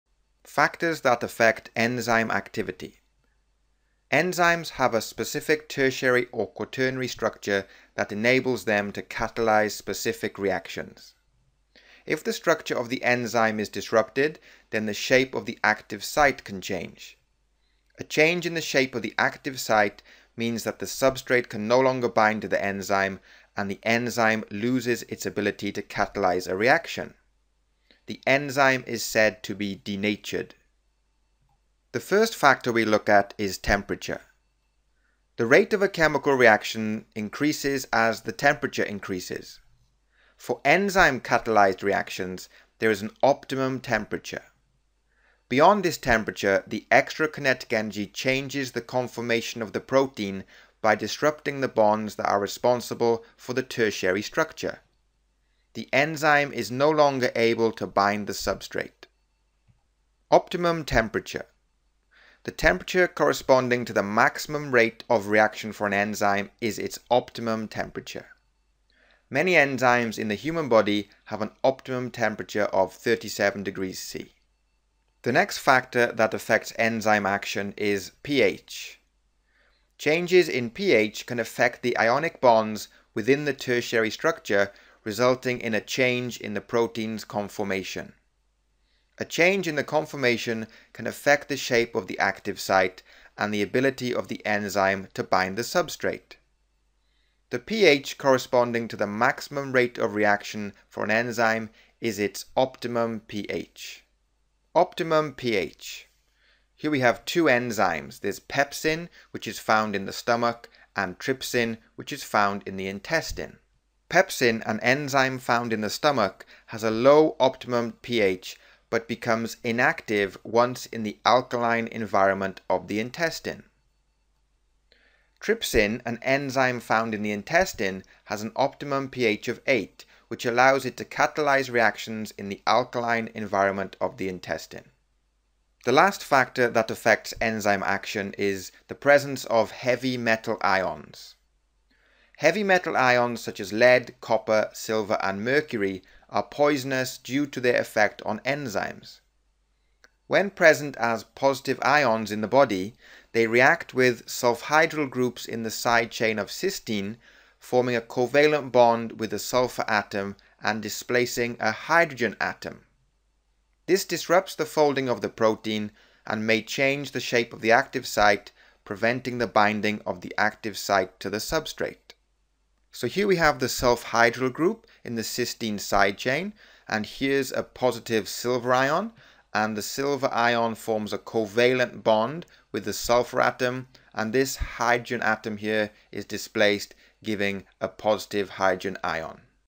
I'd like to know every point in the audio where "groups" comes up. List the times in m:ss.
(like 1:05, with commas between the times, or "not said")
2:35, 2:54.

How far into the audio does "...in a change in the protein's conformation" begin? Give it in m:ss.
1:25.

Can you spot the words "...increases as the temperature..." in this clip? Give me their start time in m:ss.
0:37.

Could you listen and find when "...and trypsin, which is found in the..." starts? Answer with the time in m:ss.
1:50.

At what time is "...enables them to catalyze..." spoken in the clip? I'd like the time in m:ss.
0:08.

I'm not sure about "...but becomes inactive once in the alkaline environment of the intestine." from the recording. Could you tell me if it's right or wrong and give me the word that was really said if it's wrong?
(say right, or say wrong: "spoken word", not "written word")
right.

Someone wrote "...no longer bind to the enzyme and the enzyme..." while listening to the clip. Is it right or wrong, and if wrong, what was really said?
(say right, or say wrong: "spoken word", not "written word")
right.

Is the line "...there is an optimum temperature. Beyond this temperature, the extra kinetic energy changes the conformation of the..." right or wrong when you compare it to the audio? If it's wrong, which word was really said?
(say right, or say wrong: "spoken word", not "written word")
right.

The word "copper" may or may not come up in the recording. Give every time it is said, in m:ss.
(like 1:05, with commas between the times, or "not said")
2:24.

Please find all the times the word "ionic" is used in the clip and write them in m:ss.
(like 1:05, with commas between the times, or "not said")
1:21.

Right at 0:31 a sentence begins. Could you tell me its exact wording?
The first factor we look at is temperature.